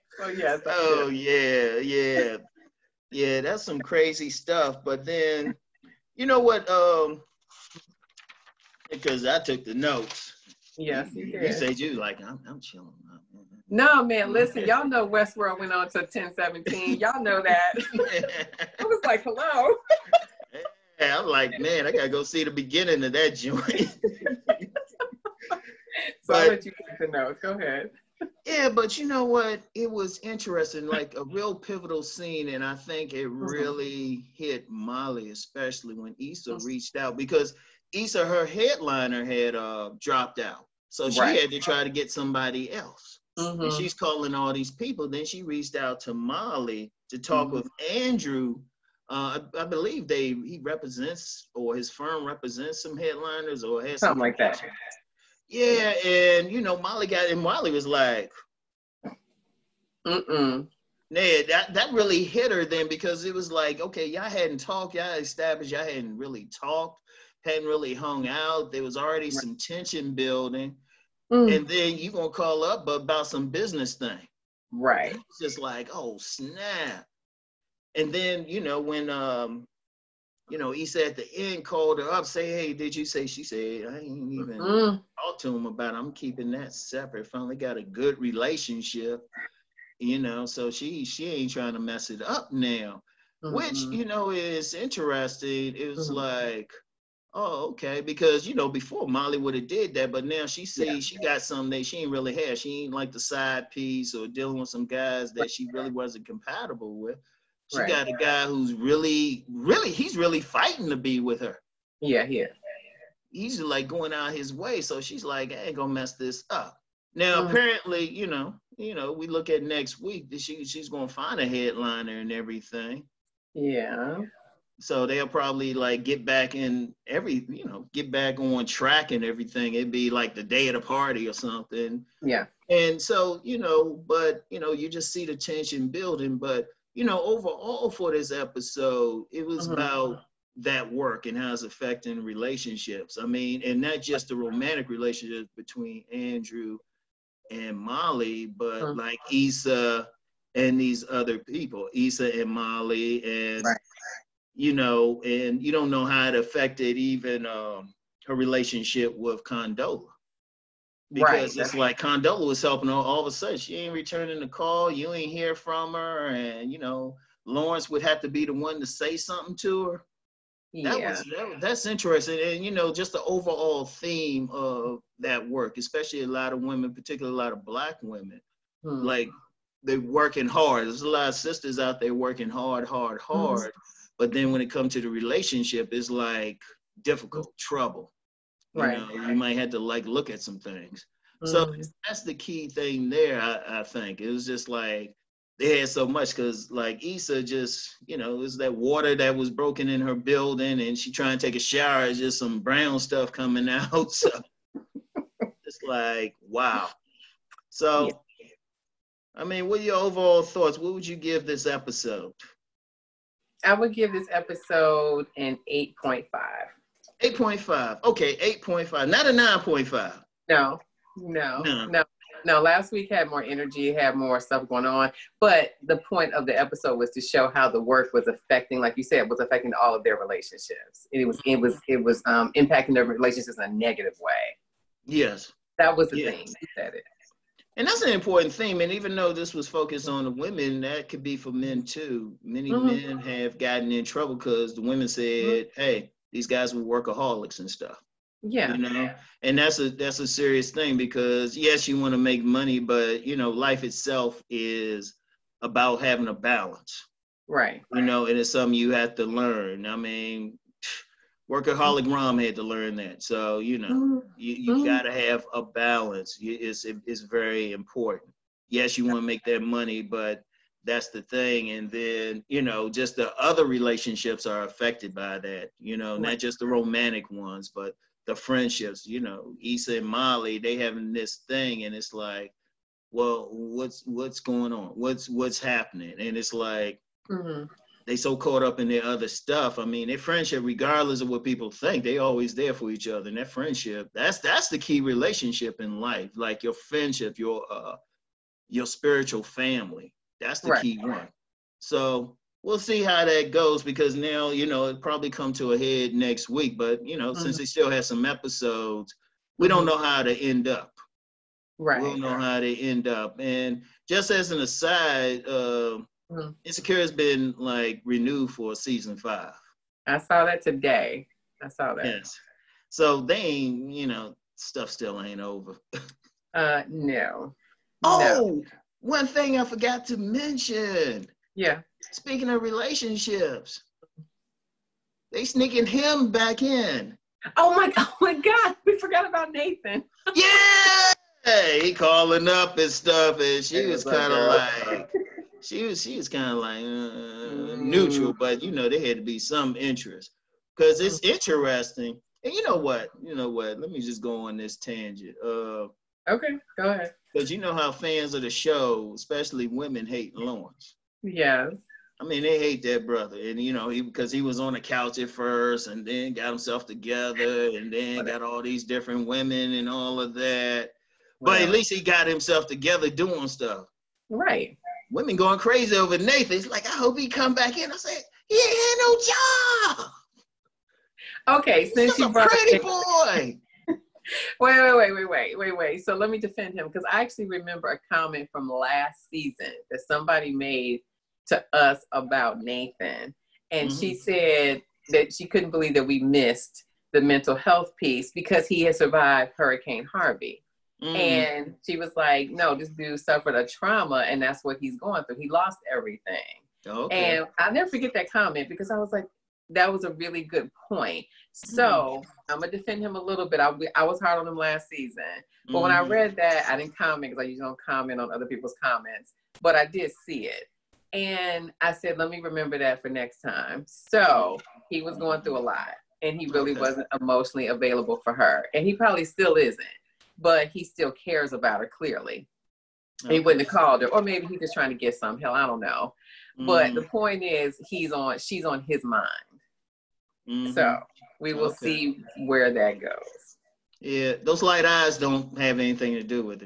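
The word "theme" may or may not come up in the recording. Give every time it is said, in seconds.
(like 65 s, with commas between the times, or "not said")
173 s, 238 s.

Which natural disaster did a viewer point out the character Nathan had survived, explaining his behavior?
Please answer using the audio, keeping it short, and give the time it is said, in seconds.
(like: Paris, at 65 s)
Hurricane Harvey, at 399 s.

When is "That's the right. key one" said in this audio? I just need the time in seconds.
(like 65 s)
300 s.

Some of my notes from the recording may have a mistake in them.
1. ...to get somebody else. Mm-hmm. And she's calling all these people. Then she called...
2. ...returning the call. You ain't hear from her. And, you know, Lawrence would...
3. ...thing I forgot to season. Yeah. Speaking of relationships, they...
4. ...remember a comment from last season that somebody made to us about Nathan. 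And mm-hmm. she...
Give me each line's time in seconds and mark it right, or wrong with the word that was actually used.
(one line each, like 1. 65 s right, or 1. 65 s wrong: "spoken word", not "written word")
1. 41 s wrong: "reached", not "called"
2. 163 s right
3. 329 s wrong: "mention", not "season"
4. 387 s right.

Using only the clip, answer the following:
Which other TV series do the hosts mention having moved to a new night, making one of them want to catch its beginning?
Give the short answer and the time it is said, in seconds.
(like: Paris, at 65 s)
Westworld, at 15 s.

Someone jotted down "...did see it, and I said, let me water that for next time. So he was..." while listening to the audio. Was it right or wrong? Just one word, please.
wrong.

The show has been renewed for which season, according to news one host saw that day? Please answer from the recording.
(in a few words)
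Season 5.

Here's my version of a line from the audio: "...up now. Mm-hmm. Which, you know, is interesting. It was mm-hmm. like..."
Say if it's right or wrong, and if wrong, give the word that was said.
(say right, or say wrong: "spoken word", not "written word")
right.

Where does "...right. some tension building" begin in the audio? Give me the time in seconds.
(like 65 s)
69 s.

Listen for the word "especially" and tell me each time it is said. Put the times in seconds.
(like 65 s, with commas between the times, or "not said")
35 s, 175 s, 359 s.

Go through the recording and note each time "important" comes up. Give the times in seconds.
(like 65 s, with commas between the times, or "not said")
238 s, 267 s.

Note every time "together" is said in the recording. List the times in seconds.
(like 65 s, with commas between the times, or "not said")
366 s, 372 s.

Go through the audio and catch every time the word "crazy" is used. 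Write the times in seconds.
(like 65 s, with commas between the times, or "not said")
3 s, 375 s.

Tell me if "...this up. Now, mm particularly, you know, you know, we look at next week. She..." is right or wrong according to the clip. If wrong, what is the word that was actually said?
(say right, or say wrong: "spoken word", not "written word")
wrong: "apparently", not "particularly".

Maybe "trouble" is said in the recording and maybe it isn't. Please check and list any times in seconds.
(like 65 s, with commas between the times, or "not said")
187 s, 244 s.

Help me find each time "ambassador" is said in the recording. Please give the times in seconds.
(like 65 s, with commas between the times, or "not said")
not said.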